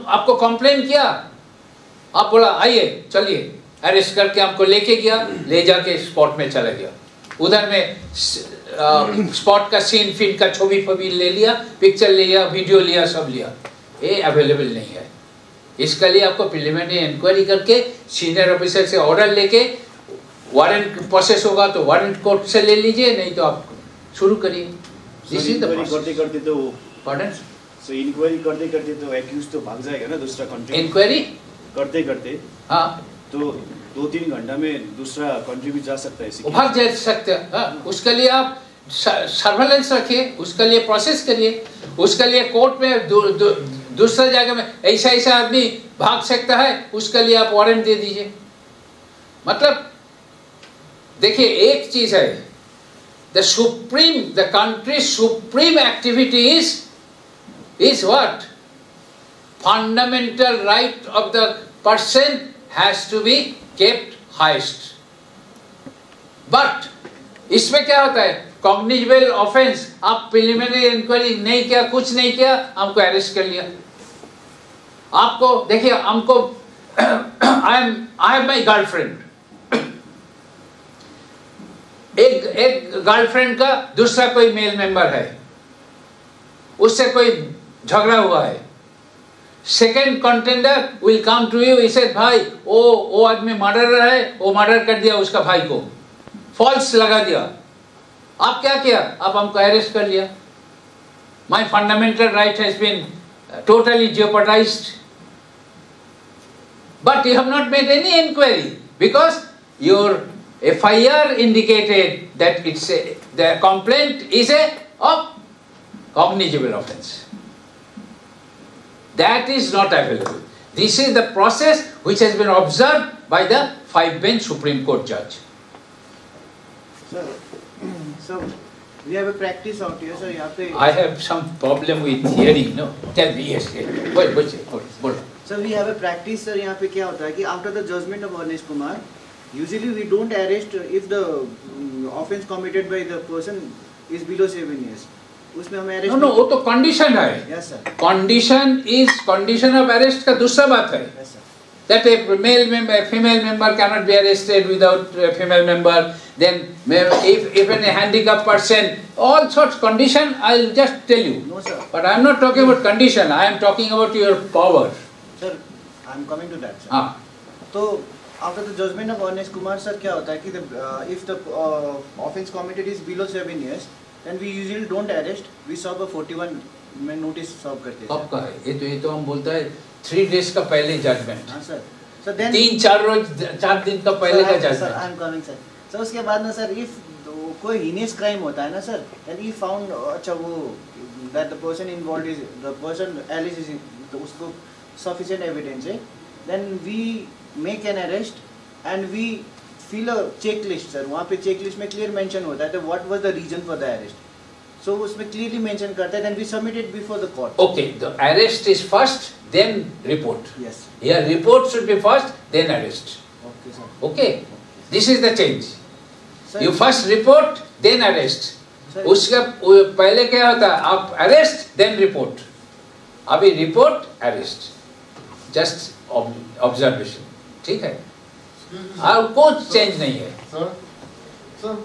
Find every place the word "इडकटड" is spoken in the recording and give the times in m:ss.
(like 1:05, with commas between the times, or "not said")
1:51.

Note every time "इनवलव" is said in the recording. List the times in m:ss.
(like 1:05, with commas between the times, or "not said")
3:11.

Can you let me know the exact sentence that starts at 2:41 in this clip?
But I'm not talking about condition.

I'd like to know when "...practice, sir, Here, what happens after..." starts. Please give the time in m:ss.
2:15.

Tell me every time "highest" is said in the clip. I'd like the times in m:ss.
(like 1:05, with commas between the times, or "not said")
1:04.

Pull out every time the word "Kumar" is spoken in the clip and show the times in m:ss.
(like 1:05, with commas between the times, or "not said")
2:18, 2:49.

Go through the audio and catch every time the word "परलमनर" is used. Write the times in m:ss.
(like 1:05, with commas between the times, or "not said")
0:16, 1:10.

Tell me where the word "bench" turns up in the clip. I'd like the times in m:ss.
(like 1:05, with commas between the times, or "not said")
2:04.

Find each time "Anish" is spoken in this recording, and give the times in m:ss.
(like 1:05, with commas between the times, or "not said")
2:18.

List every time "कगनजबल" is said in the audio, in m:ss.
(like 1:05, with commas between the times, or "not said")
1:08.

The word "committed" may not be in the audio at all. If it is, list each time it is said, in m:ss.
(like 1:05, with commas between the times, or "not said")
2:22, 2:52.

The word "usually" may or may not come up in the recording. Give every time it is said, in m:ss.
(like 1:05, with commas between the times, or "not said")
2:19, 2:54.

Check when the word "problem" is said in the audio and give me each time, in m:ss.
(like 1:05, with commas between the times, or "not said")
2:11.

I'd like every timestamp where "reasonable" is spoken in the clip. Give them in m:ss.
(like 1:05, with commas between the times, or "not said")
not said.